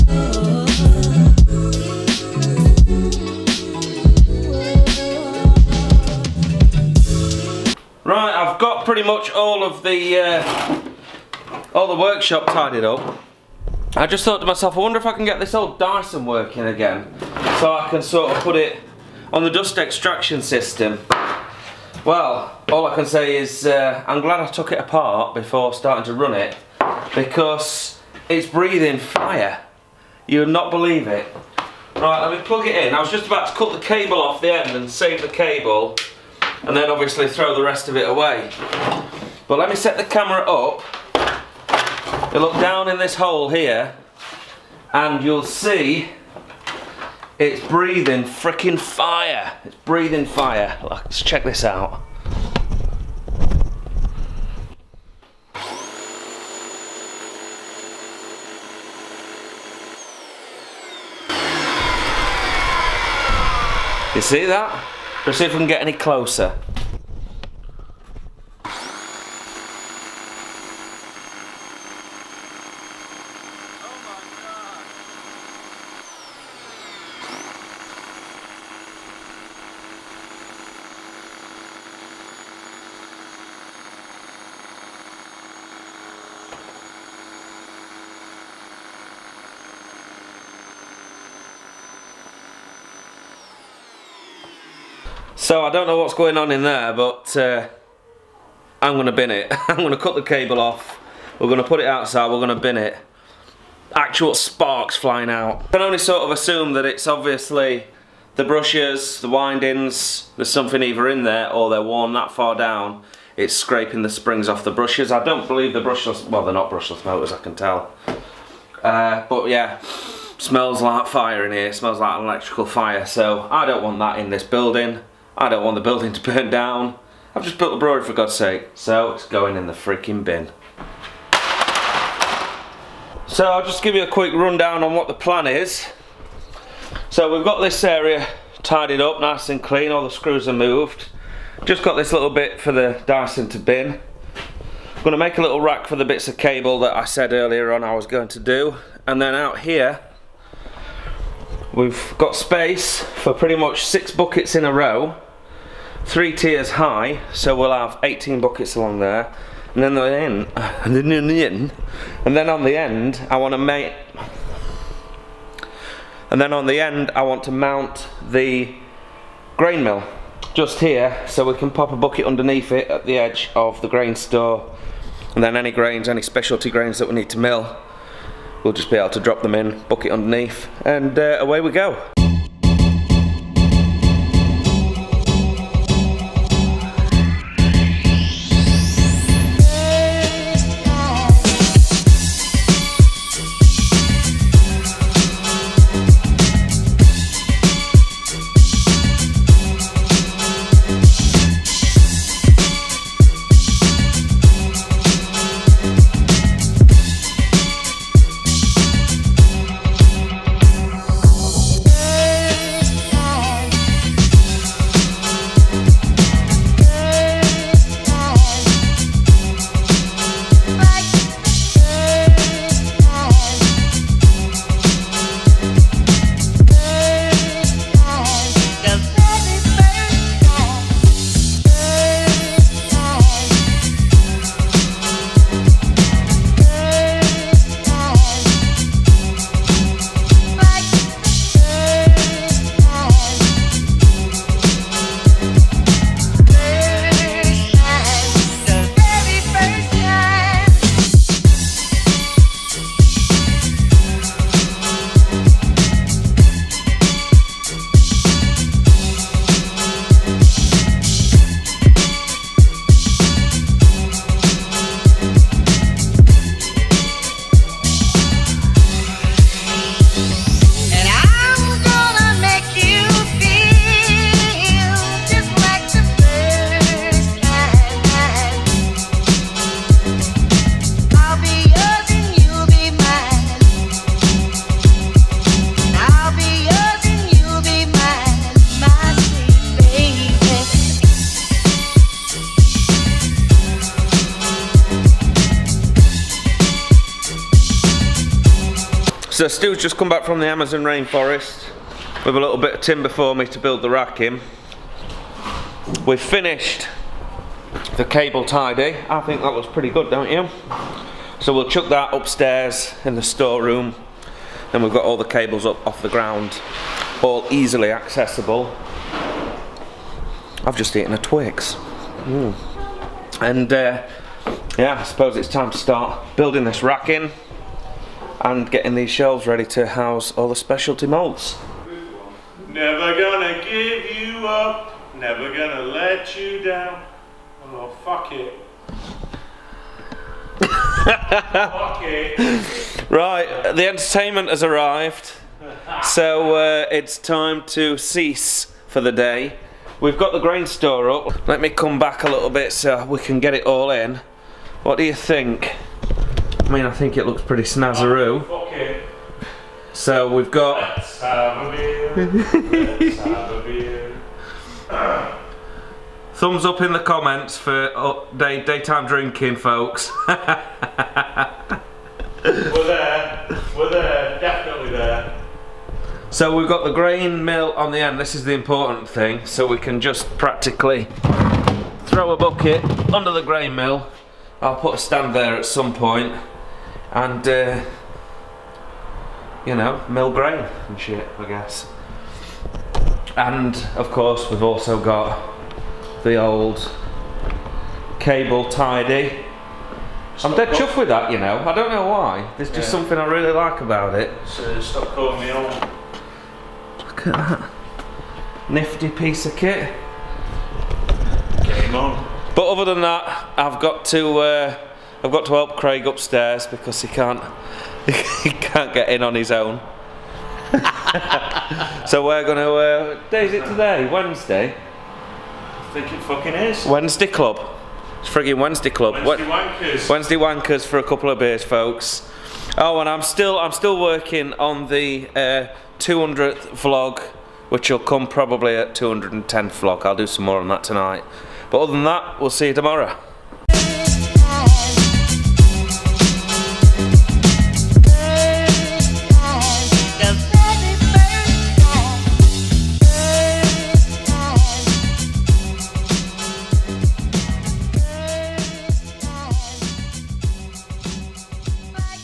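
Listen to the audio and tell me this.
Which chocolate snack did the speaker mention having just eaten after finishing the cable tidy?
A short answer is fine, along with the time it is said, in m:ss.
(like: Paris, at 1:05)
Twix, at 5:21.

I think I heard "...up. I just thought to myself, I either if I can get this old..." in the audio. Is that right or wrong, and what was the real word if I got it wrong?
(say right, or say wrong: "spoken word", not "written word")
wrong: "wonder", not "either".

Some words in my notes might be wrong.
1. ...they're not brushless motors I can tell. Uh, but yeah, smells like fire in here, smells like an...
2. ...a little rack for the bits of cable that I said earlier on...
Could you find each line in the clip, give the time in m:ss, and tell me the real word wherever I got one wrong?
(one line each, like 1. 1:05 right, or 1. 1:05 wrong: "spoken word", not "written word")
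1. 1:56 right
2. 2:25 right.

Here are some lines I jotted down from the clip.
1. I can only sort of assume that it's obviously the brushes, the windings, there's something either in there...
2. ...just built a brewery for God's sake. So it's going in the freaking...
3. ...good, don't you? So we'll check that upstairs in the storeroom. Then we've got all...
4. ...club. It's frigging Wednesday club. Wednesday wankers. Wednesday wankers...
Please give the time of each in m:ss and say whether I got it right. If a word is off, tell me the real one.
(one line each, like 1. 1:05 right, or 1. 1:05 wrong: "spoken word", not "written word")
1. 1:45 right
2. 2:07 right
3. 5:09 wrong: "chuck", not "check"
4. 7:07 right.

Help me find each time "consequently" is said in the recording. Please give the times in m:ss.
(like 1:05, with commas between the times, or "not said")
not said.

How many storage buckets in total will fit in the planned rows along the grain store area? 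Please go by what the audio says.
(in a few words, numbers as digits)
18.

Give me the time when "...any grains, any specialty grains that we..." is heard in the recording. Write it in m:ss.
2:55.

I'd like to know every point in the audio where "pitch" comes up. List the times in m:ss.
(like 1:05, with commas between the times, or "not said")
not said.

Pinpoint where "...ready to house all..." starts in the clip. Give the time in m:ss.
5:29.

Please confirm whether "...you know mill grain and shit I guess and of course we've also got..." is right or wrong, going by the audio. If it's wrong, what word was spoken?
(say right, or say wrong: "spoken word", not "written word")
right.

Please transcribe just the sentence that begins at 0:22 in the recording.
Well, all I can say is uh, I'm glad I took it apart before starting to run it, because it's breathing fire.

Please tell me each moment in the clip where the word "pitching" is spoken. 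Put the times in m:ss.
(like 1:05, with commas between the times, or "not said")
not said.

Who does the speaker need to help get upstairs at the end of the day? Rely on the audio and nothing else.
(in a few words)
Craig.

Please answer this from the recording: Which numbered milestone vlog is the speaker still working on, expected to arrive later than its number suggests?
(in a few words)
200th vlog.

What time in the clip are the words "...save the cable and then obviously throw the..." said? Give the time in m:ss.
0:34.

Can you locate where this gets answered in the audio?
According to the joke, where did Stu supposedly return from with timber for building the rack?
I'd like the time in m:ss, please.
5:00.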